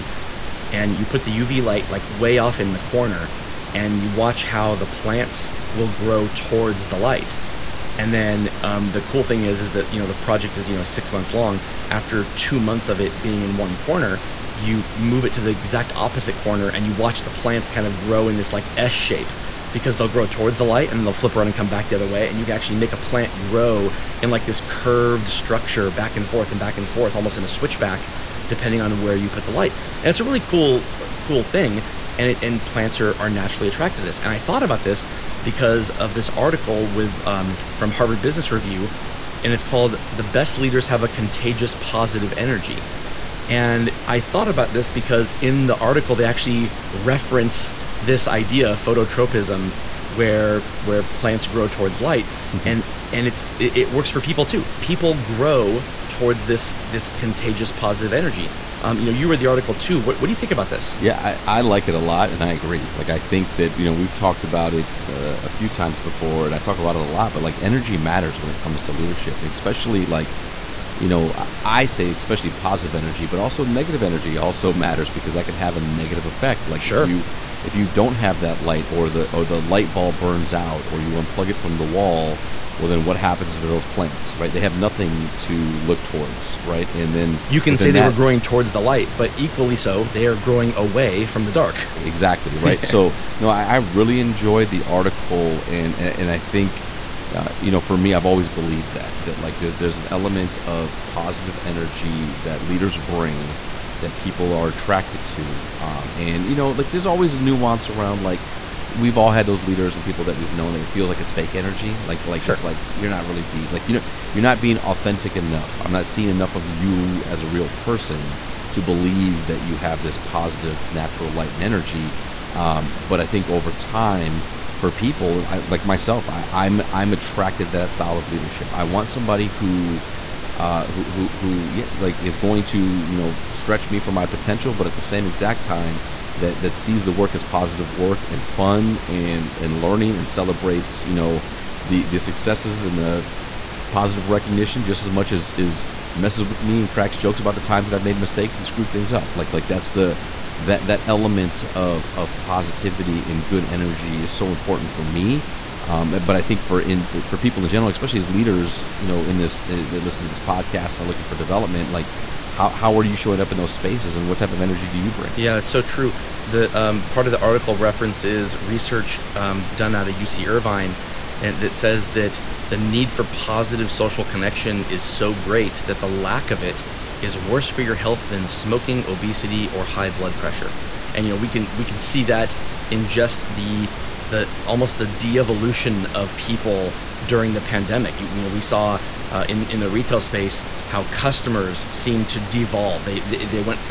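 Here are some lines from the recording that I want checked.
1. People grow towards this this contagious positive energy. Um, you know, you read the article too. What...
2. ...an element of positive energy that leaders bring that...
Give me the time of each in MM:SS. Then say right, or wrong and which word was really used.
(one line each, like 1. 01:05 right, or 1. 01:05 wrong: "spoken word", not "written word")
1. 00:54 right
2. 01:39 right.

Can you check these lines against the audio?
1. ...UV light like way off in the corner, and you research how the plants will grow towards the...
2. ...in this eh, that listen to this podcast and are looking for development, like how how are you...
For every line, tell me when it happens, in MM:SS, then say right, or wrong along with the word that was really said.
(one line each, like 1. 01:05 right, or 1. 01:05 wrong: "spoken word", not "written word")
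1. 00:01 wrong: "watch", not "research"
2. 02:39 right.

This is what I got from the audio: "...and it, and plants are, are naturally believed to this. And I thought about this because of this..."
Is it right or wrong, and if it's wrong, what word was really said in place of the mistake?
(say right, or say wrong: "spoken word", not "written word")
wrong: "attracted", not "believed".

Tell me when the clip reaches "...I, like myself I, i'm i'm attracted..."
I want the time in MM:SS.
02:05.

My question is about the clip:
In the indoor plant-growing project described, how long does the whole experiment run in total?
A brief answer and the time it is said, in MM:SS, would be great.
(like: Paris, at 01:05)
6 months, at 00:10.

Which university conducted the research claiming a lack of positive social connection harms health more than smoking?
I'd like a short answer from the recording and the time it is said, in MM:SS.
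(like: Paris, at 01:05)
UC Irvine, at 02:50.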